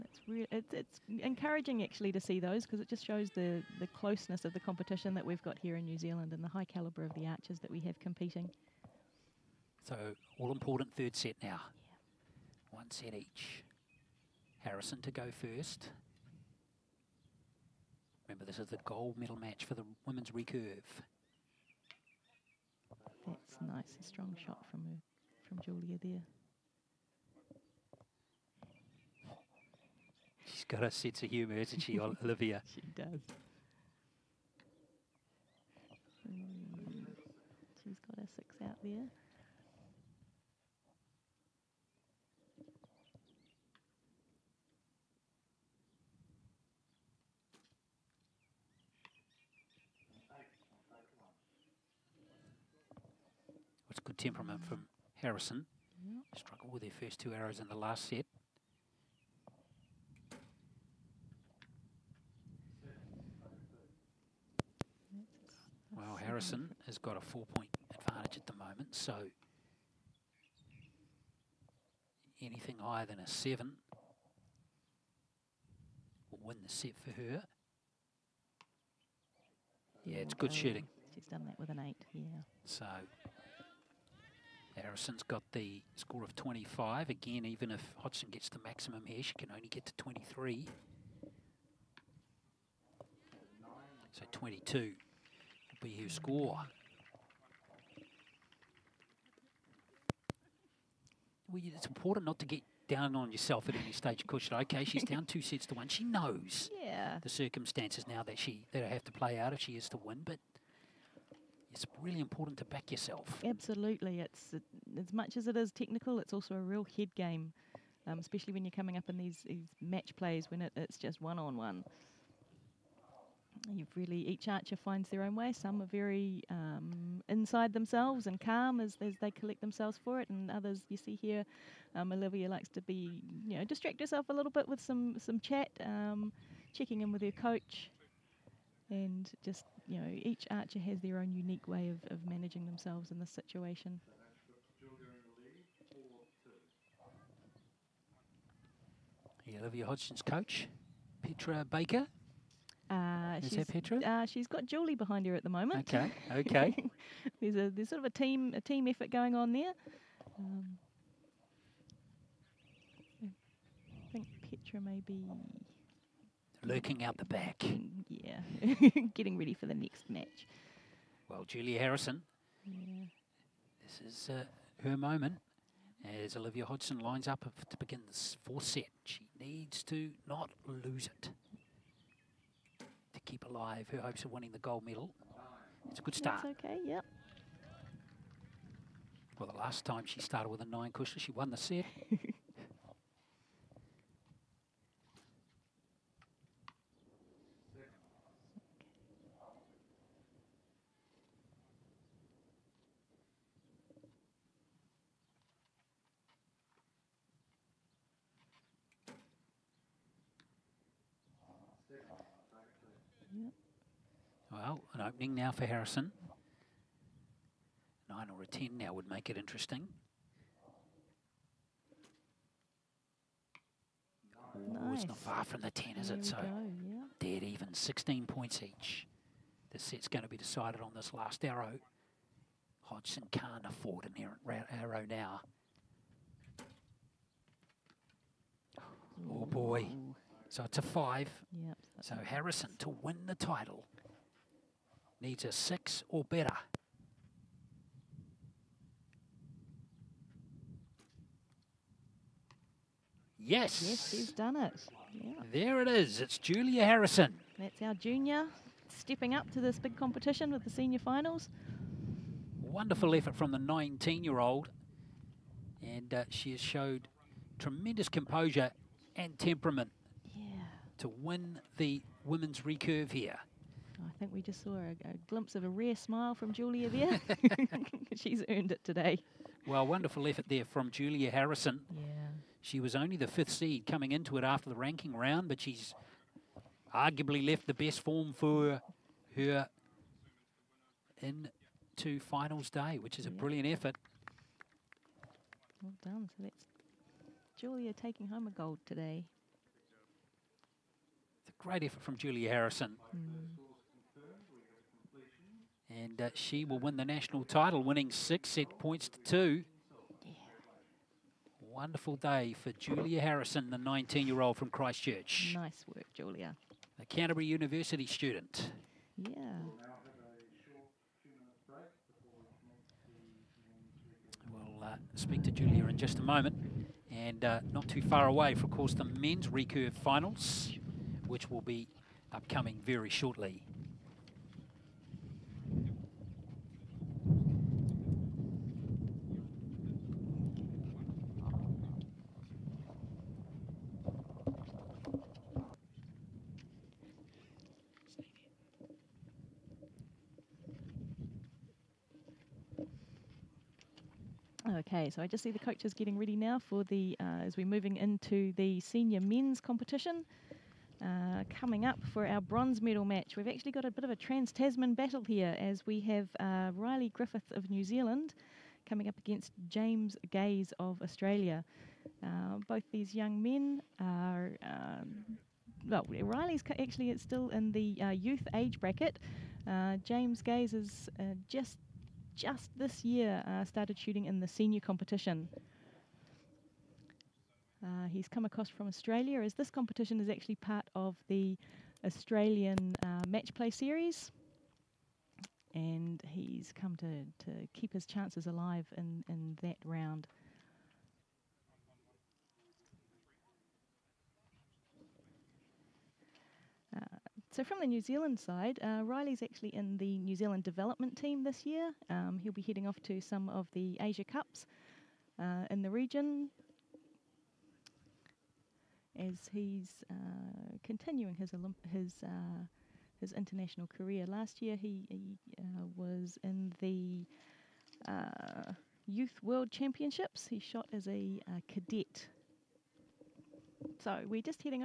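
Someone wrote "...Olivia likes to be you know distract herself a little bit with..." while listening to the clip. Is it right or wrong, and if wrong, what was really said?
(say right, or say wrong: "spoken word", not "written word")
right.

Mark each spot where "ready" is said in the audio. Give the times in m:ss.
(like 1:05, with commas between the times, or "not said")
2:49, 5:56.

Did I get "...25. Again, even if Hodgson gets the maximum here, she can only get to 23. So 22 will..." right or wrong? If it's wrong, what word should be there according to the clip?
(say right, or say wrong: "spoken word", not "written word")
right.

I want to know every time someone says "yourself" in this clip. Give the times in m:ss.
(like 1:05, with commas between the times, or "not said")
1:43, 1:52.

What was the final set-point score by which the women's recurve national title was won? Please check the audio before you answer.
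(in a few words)
6 to 2.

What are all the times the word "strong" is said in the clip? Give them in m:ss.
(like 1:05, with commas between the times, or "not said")
0:24.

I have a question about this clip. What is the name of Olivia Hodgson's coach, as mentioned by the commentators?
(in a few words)
Petra Baker.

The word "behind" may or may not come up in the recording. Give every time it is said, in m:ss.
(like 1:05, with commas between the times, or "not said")
2:34.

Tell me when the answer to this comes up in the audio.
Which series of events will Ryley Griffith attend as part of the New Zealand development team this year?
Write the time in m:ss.
6:54.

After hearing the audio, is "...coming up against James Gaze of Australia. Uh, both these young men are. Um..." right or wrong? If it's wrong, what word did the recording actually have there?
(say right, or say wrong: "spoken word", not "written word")
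right.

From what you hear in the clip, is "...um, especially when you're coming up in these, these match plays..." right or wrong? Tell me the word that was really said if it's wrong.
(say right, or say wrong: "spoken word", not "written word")
right.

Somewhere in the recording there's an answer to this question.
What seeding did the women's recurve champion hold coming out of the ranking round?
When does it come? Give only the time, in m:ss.
4:43.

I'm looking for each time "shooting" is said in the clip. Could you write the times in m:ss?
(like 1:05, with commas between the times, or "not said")
1:20, 6:23.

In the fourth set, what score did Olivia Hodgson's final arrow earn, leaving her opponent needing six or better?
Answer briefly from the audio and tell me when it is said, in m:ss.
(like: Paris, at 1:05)
5, at 4:00.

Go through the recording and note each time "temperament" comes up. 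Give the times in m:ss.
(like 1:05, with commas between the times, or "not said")
0:54, 4:29.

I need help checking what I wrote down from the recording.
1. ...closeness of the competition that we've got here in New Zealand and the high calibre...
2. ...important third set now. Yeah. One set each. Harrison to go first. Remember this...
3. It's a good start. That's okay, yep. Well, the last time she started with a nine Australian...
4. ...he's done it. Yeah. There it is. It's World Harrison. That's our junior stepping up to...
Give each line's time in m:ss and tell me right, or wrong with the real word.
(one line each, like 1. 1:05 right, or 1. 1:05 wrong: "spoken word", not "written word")
1. 0:03 right
2. 0:10 right
3. 3:05 wrong: "Kushla", not "Australian"
4. 4:14 wrong: "Julia", not "World".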